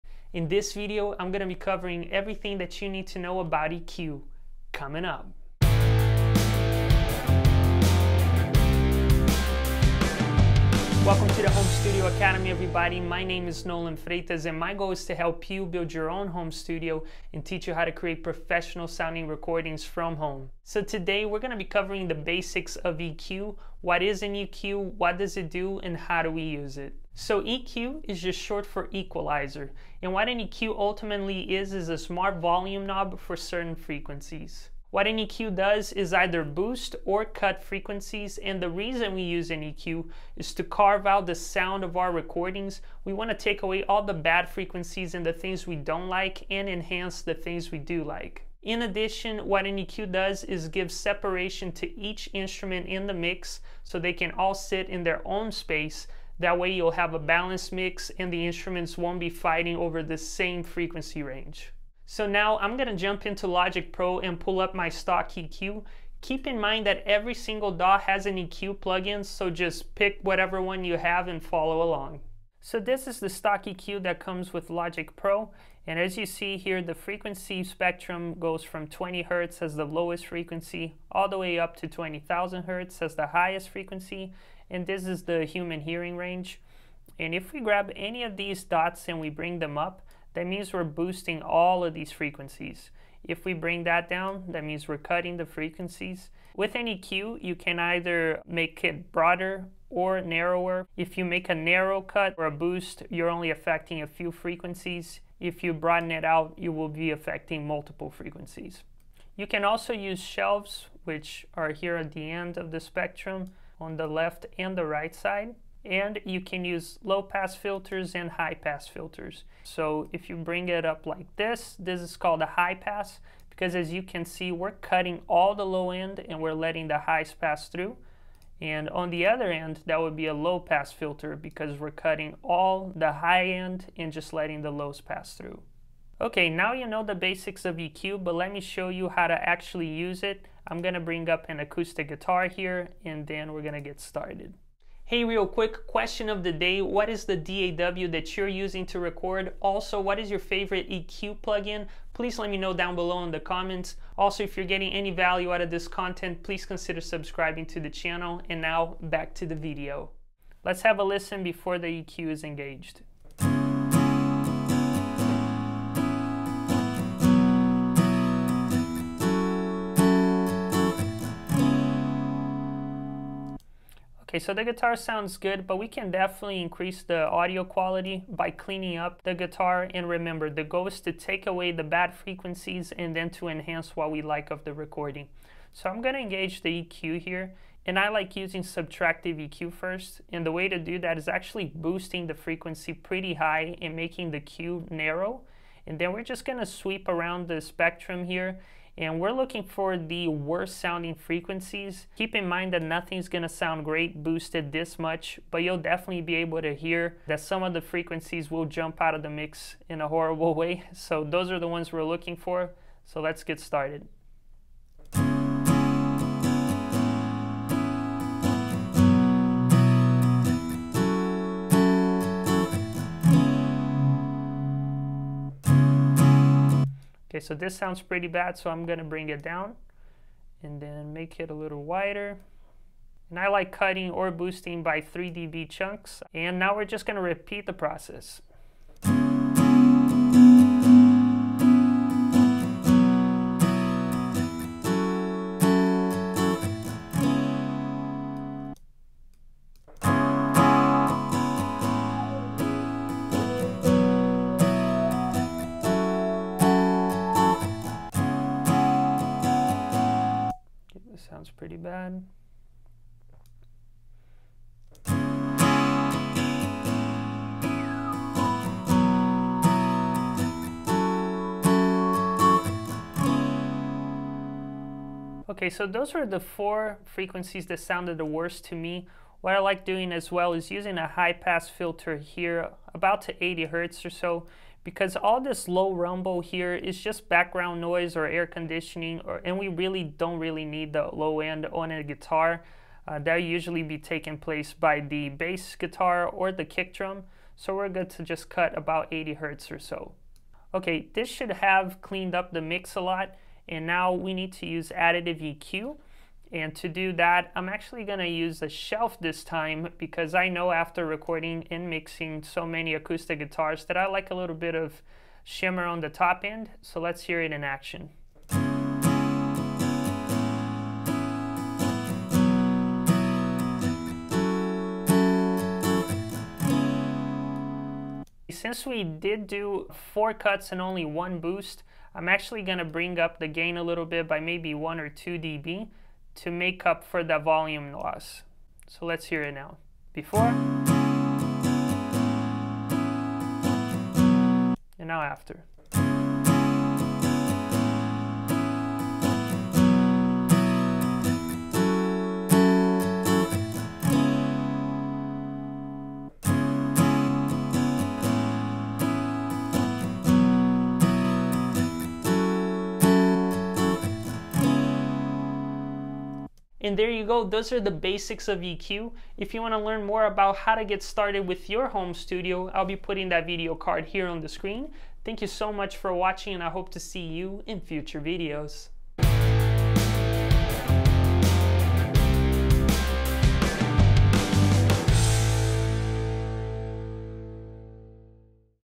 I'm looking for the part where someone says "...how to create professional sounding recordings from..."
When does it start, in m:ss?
0:17.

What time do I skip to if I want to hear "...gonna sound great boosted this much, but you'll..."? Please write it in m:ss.
3:23.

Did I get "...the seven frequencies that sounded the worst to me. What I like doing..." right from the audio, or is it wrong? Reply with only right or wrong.
wrong.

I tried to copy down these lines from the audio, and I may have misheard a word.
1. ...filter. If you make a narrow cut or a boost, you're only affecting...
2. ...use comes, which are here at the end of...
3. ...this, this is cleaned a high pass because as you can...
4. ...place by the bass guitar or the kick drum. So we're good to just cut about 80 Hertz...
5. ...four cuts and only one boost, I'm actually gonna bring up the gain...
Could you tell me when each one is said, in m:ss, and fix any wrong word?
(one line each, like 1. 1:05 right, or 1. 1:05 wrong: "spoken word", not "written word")
1. 1:40 wrong: "narrower", not "filter"
2. 1:49 wrong: "shelves", not "comes"
3. 2:01 wrong: "called", not "cleaned"
4. 4:54 right
5. 5:30 right.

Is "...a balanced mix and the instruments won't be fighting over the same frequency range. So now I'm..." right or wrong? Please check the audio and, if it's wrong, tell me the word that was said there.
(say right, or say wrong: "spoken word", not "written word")
right.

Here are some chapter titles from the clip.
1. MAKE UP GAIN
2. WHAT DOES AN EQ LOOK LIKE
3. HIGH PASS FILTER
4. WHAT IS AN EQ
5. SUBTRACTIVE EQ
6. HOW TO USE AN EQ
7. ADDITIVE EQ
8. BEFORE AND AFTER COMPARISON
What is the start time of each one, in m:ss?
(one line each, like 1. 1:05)
1. 5:28
2. 1:13
3. 4:39
4. 0:27
5. 3:07
6. 1:27
7. 5:04
8. 5:38.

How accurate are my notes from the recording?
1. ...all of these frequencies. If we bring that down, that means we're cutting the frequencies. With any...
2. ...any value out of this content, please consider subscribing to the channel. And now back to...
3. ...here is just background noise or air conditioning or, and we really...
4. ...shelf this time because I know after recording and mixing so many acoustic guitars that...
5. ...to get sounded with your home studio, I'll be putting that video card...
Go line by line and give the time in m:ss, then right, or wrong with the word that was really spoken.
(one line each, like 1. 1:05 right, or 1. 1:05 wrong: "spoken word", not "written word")
1. 1:31 right
2. 2:34 right
3. 4:46 right
4. 5:08 right
5. 6:10 wrong: "started", not "sounded".